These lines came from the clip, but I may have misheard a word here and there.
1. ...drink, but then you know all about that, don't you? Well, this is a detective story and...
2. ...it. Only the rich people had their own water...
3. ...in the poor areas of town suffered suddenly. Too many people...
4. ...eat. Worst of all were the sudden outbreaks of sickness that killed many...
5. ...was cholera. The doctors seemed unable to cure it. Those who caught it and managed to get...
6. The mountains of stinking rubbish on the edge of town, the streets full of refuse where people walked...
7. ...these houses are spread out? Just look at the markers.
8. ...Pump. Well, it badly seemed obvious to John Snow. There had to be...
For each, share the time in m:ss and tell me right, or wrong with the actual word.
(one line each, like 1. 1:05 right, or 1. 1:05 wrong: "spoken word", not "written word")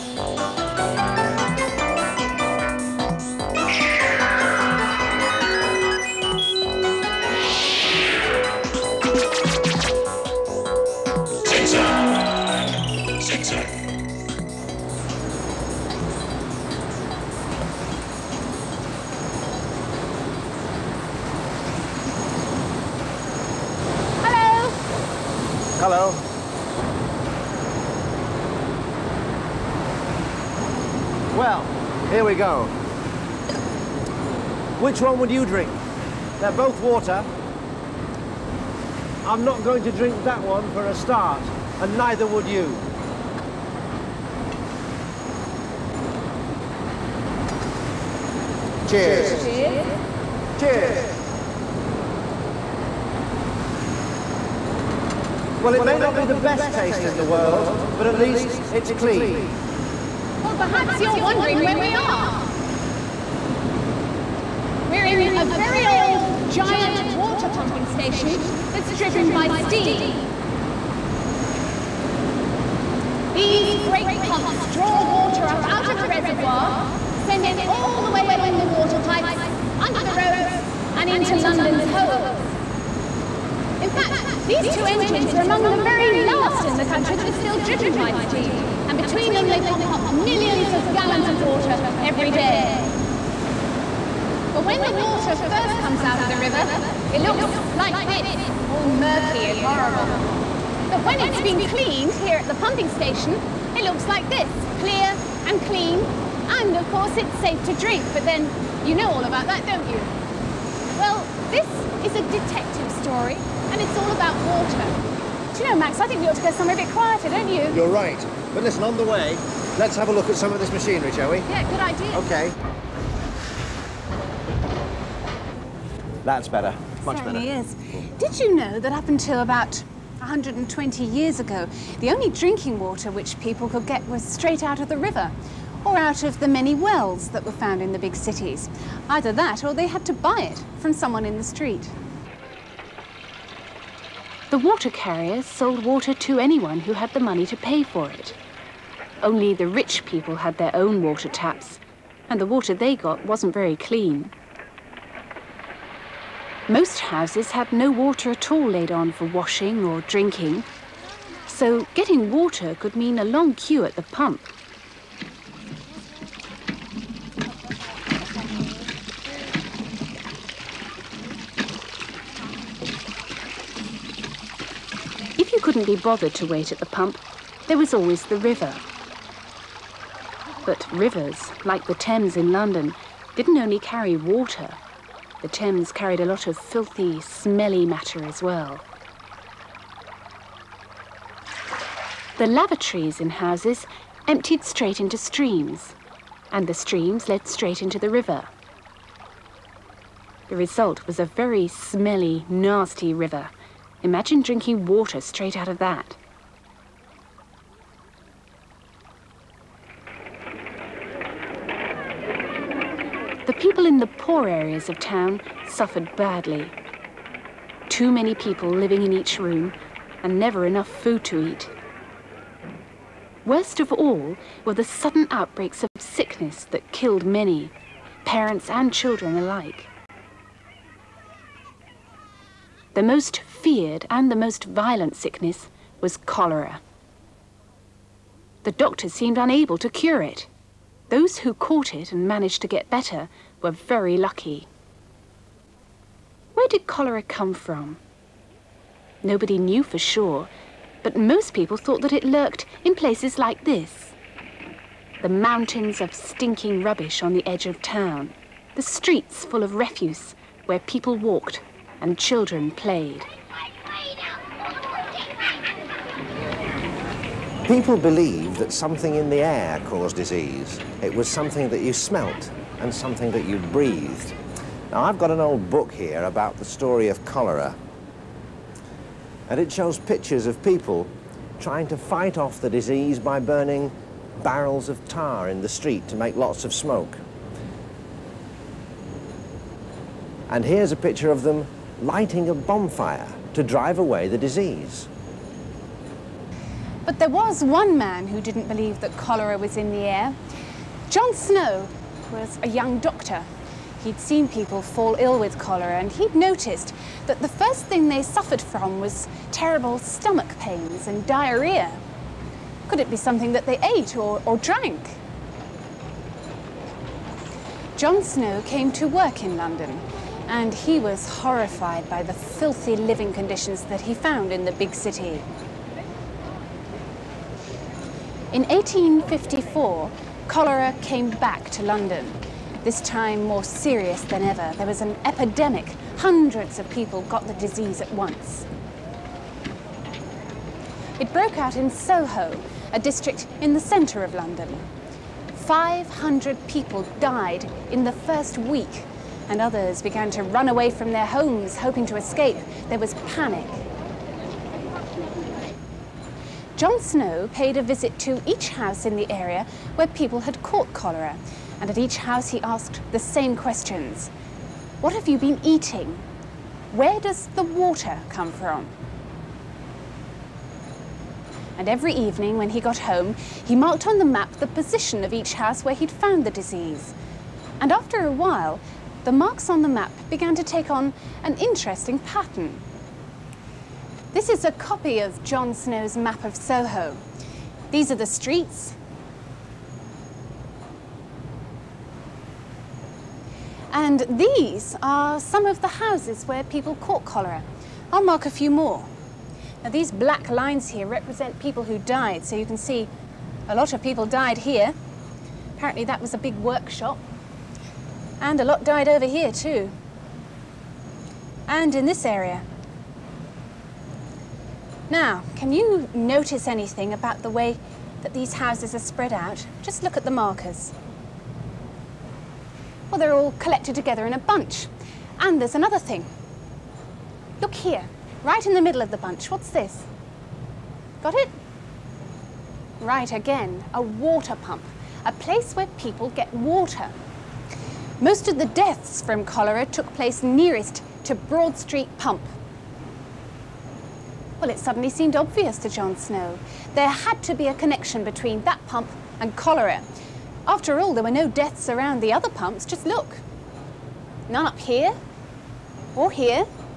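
1. 1:47 right
2. 2:28 right
3. 3:33 wrong: "badly", not "suddenly"
4. 3:41 right
5. 3:56 right
6. 4:15 right
7. 6:58 right
8. 7:22 wrong: "suddenly", not "badly".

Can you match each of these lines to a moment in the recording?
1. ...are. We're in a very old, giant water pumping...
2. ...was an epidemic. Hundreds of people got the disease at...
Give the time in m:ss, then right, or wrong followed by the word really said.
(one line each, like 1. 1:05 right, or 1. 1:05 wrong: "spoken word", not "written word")
1. 1:01 right
2. 5:34 right.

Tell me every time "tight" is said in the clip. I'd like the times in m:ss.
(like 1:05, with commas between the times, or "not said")
not said.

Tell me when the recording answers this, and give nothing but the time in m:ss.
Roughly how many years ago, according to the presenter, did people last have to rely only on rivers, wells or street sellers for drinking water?
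2:10.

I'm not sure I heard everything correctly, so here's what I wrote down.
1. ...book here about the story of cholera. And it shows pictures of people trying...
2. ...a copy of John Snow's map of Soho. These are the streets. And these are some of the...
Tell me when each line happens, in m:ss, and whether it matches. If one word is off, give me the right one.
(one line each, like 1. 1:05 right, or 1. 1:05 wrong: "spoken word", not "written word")
1. 4:35 right
2. 6:24 right.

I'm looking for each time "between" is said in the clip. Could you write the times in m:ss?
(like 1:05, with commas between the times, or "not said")
1:28, 7:28.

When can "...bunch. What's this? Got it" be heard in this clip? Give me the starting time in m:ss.
7:09.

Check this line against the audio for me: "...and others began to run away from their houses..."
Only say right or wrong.
wrong.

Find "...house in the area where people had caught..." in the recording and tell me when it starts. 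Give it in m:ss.
5:58.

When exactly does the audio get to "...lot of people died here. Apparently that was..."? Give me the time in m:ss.
6:43.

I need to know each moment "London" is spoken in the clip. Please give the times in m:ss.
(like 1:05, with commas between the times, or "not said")
1:21, 3:02, 5:19, 5:31, 5:44.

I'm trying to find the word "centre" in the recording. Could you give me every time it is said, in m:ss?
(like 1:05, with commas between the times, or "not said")
5:43.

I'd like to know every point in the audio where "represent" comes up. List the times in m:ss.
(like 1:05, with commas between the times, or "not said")
6:41.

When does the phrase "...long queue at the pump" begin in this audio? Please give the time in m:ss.
2:43.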